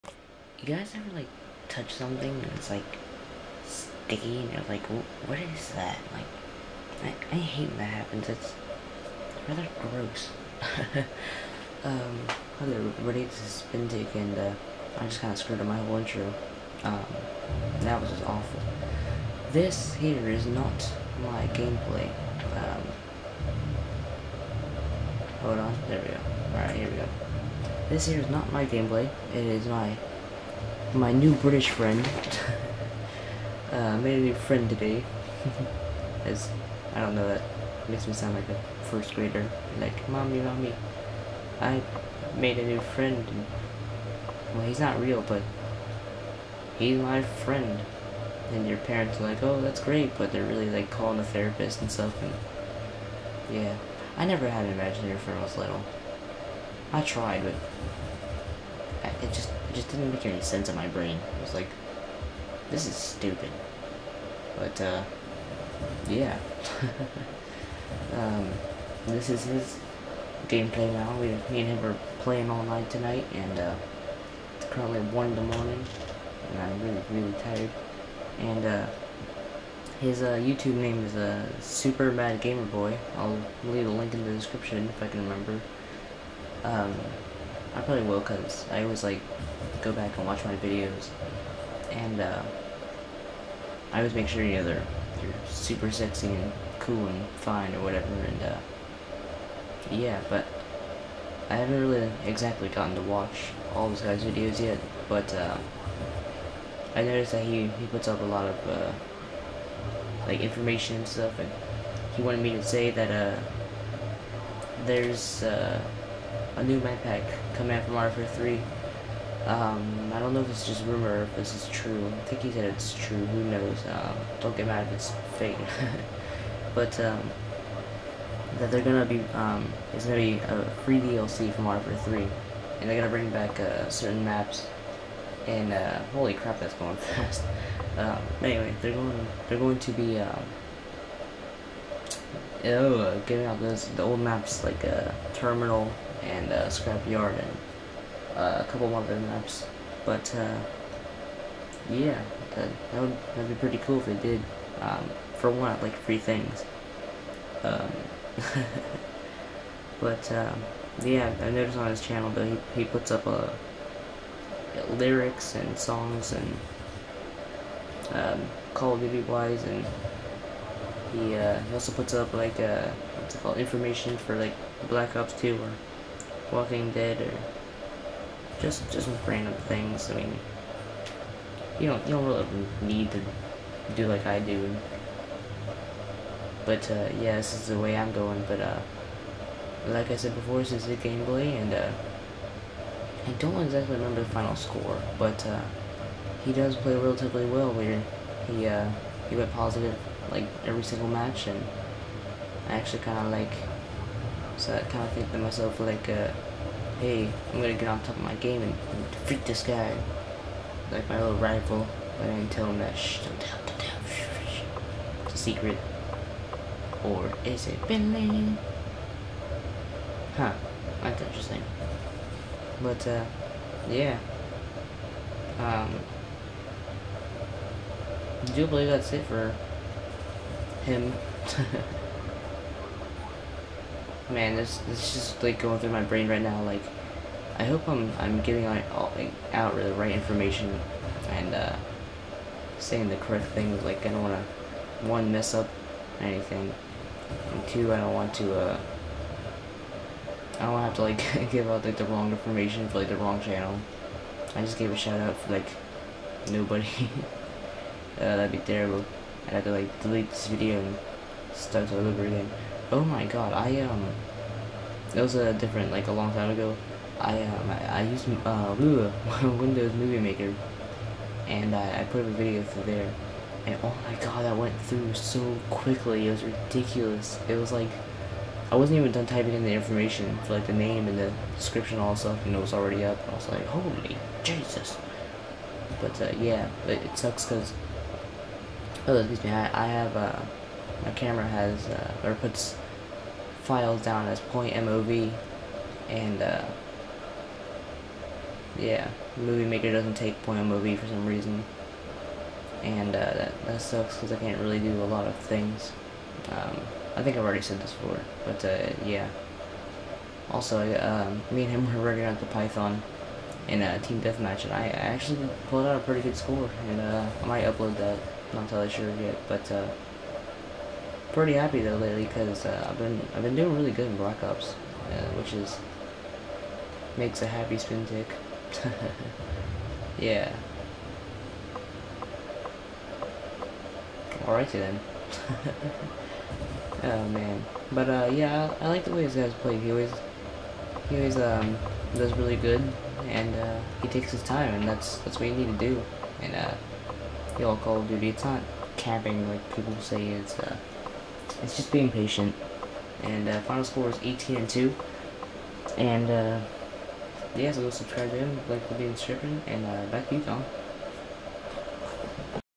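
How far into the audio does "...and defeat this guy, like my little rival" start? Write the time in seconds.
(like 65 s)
208 s.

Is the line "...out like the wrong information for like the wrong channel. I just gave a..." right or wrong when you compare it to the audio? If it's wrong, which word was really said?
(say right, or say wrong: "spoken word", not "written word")
right.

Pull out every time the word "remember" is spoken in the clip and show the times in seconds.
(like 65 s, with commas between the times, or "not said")
85 s, 193 s.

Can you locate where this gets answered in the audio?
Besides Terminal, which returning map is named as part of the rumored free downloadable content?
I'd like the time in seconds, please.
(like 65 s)
146 s.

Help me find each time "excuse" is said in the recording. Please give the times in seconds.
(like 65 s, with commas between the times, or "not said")
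289 s.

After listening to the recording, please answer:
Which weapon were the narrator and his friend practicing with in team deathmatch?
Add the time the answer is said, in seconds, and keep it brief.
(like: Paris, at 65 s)
Python, at 312 s.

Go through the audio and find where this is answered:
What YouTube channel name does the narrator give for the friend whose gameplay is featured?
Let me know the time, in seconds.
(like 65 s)
81 s.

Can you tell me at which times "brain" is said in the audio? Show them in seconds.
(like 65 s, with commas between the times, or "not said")
60 s, 236 s.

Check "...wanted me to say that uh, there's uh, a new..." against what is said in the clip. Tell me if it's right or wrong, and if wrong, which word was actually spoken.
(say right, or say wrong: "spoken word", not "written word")
right.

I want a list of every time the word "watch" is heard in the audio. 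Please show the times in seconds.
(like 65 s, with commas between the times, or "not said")
90 s, 103 s.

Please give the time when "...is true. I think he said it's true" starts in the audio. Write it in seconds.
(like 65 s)
121 s.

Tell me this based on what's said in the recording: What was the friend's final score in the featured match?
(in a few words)
18 and 2.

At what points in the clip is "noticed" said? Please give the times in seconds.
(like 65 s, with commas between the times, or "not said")
107 s, 161 s.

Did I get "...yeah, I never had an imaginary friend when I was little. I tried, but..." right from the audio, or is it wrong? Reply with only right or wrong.
right.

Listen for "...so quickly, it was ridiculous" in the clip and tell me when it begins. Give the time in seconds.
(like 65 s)
275 s.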